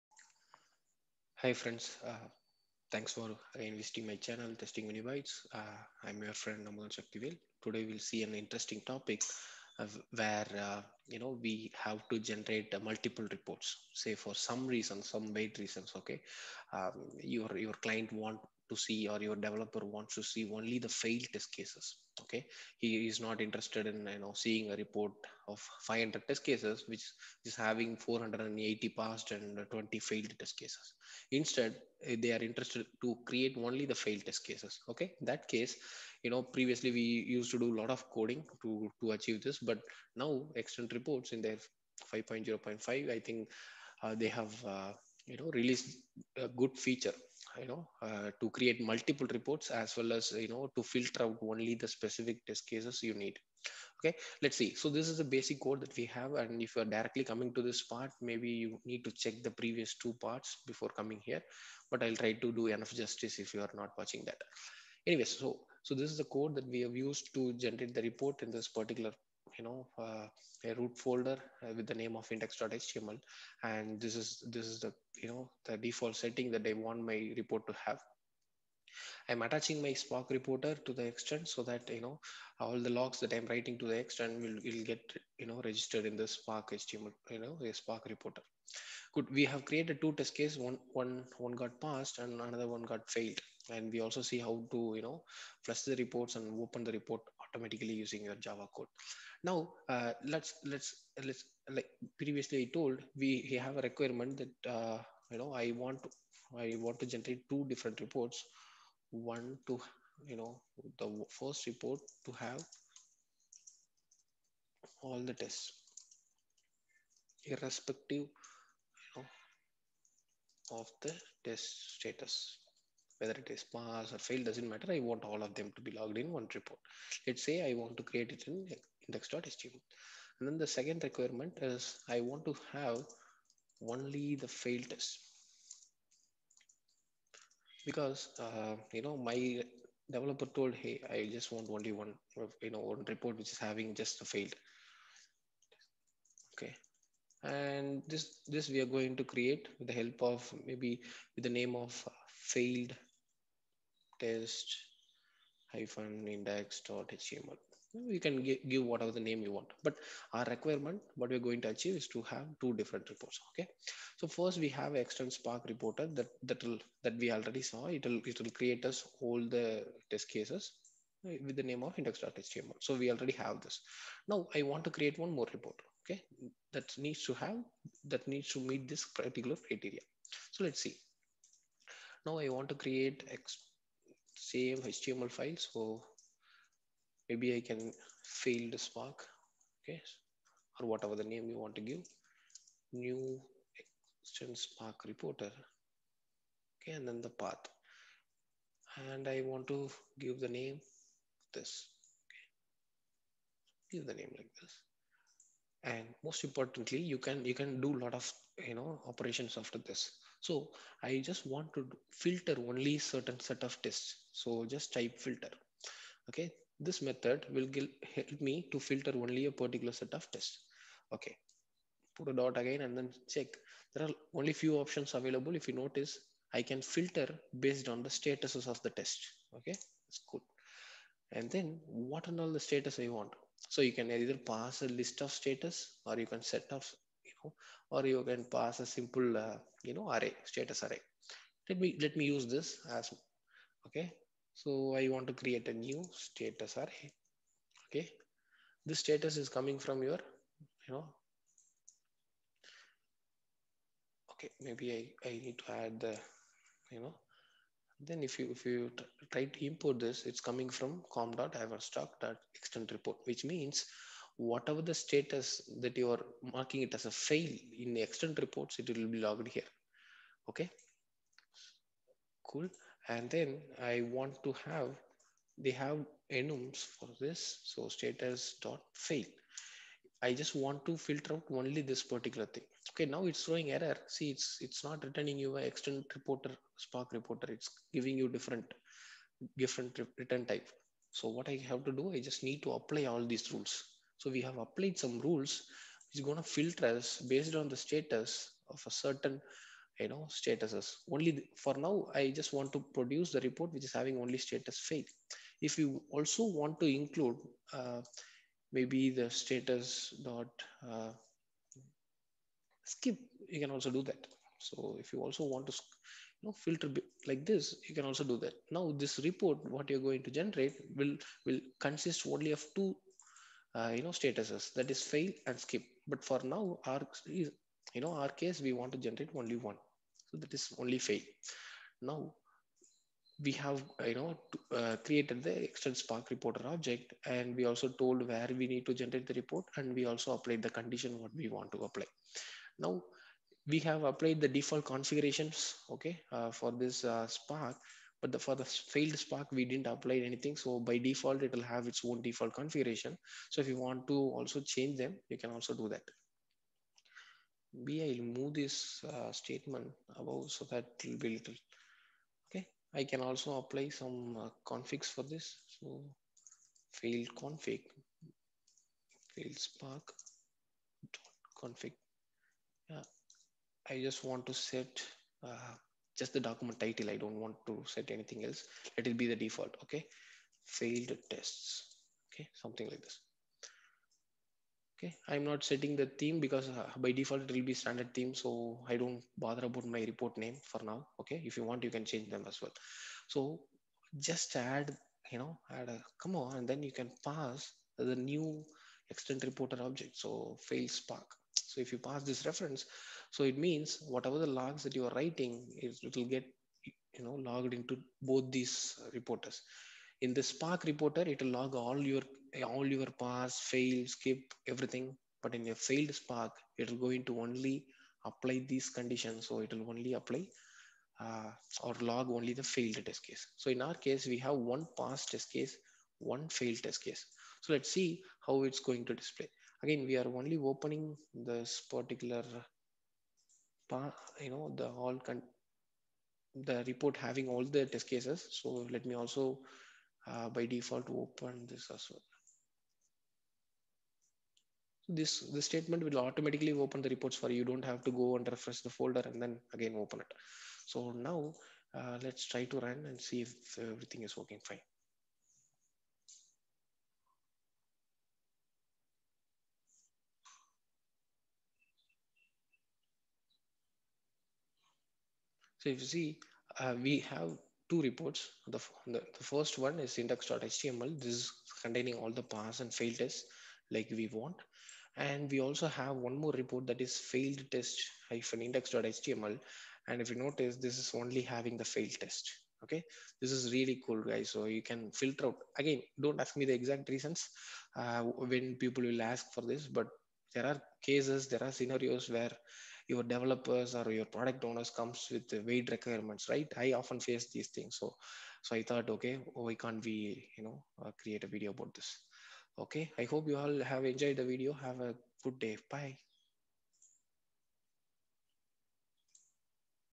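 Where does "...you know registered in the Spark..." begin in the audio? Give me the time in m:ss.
1:25.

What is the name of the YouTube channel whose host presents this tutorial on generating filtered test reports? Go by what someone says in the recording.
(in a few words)
Testing Mini.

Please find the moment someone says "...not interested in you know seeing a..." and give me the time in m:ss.
0:23.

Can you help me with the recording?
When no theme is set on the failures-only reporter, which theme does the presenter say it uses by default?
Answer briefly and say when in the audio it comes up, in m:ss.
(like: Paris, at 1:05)
standard theme, at 6:27.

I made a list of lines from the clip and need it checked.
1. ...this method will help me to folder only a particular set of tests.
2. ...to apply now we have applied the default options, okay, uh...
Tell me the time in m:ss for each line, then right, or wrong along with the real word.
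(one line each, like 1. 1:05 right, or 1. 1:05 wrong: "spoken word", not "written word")
1. 3:36 wrong: "filter", not "folder"
2. 5:41 wrong: "configurations", not "options".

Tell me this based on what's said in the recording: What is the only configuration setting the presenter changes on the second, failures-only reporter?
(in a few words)
document title.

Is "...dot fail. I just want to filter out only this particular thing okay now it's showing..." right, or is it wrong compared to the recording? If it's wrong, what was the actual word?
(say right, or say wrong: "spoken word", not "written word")
right.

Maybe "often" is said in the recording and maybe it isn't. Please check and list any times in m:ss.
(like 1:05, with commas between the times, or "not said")
8:17.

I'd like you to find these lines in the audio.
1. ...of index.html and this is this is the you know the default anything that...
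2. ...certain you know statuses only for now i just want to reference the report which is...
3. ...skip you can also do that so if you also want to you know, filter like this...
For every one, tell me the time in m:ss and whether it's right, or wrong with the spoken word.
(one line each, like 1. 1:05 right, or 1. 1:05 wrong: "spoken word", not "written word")
1. 1:12 wrong: "setting", not "anything"
2. 4:59 wrong: "produce", not "reference"
3. 5:12 right.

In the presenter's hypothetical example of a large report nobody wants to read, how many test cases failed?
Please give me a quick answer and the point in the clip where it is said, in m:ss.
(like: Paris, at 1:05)
20, at 0:29.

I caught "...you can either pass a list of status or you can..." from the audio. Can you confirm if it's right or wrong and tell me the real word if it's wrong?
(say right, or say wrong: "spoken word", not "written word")
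right.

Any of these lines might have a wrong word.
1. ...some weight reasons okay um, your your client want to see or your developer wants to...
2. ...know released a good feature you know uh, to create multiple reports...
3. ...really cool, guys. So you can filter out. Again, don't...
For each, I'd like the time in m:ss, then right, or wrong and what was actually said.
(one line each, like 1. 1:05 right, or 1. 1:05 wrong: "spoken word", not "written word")
1. 0:15 right
2. 0:45 right
3. 8:03 right.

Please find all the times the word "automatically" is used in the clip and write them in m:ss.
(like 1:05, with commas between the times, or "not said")
1:37, 7:26.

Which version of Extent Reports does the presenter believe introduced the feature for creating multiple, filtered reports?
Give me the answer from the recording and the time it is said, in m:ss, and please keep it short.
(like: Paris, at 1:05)
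5.0.5, at 0:42.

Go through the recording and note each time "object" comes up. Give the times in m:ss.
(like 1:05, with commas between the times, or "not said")
5:36, 6:39.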